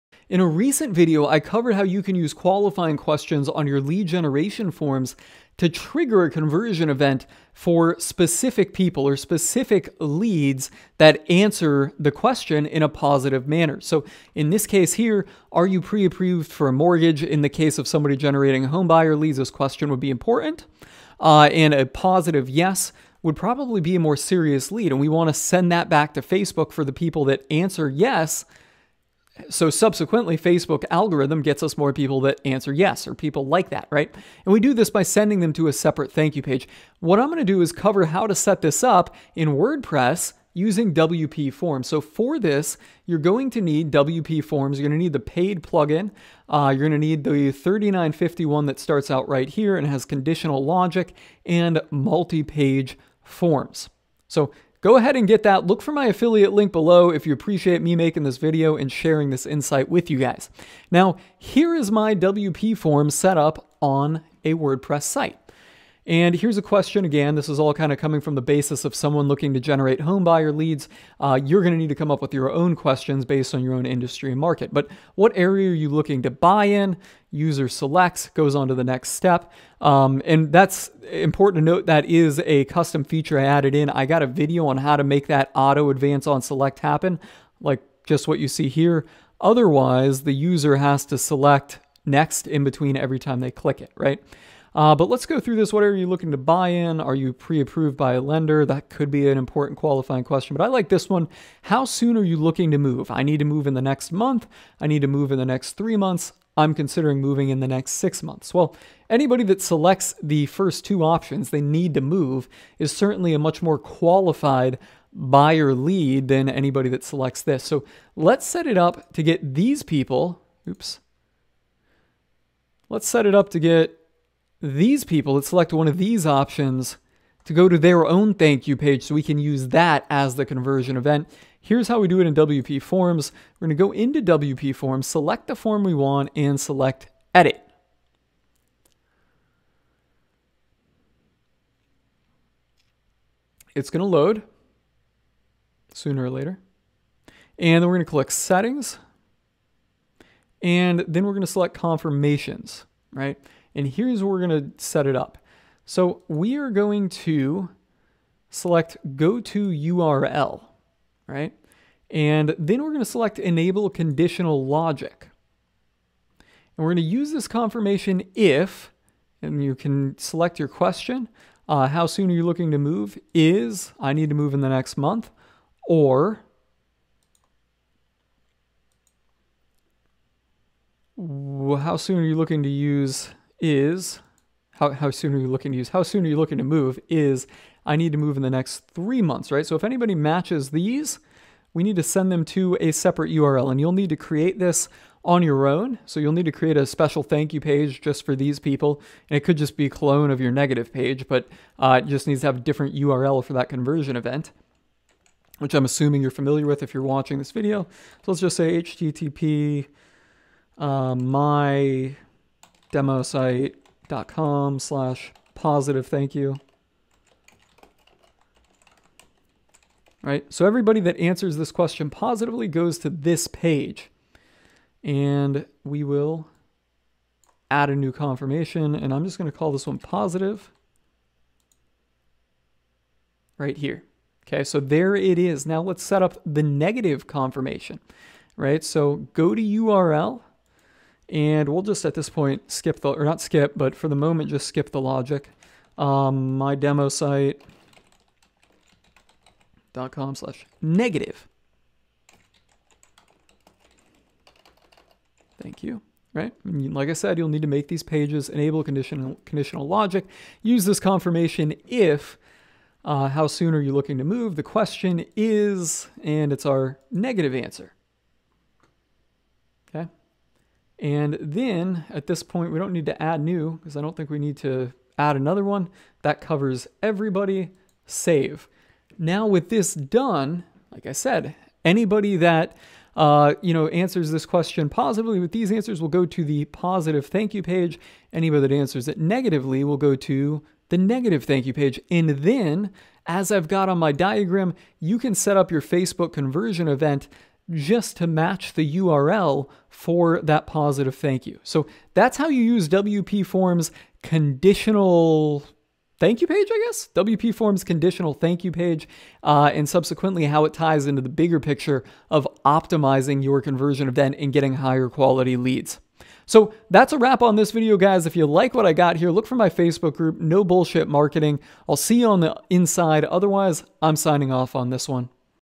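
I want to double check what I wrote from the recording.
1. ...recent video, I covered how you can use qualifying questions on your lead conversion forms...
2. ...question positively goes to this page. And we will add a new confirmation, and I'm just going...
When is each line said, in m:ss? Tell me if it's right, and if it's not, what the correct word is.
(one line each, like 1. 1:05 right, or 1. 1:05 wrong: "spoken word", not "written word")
1. 0:00 wrong: "generation", not "conversion"
2. 3:41 right.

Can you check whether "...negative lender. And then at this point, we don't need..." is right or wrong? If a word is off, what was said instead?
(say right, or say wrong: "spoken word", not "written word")
wrong: "answer", not "lender".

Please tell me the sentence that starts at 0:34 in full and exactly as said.
And we do this by sending them to a separate thank you page.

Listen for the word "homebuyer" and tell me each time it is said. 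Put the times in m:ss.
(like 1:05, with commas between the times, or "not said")
0:18, 1:09.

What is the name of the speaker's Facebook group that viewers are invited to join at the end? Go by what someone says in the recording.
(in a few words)
No Bullshit Marketing.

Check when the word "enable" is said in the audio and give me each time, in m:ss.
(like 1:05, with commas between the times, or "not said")
2:43, 4:18.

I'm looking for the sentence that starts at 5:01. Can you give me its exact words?
So that's how you use WP Forms conditional thank you page, I guess?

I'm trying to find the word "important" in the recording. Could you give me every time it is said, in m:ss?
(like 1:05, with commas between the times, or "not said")
0:20, 1:21, 1:39.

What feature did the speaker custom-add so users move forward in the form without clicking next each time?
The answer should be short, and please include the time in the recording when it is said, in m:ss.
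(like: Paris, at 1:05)
auto advance on select, at 1:25.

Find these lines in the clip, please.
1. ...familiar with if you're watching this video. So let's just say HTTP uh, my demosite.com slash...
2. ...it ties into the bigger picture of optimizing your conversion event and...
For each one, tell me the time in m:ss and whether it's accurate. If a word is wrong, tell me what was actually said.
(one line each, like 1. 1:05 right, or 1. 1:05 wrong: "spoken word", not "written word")
1. 3:26 right
2. 5:10 right.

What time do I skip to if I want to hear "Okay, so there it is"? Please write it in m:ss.
3:54.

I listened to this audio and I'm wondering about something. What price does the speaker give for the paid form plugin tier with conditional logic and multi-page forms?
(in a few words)
$39.51.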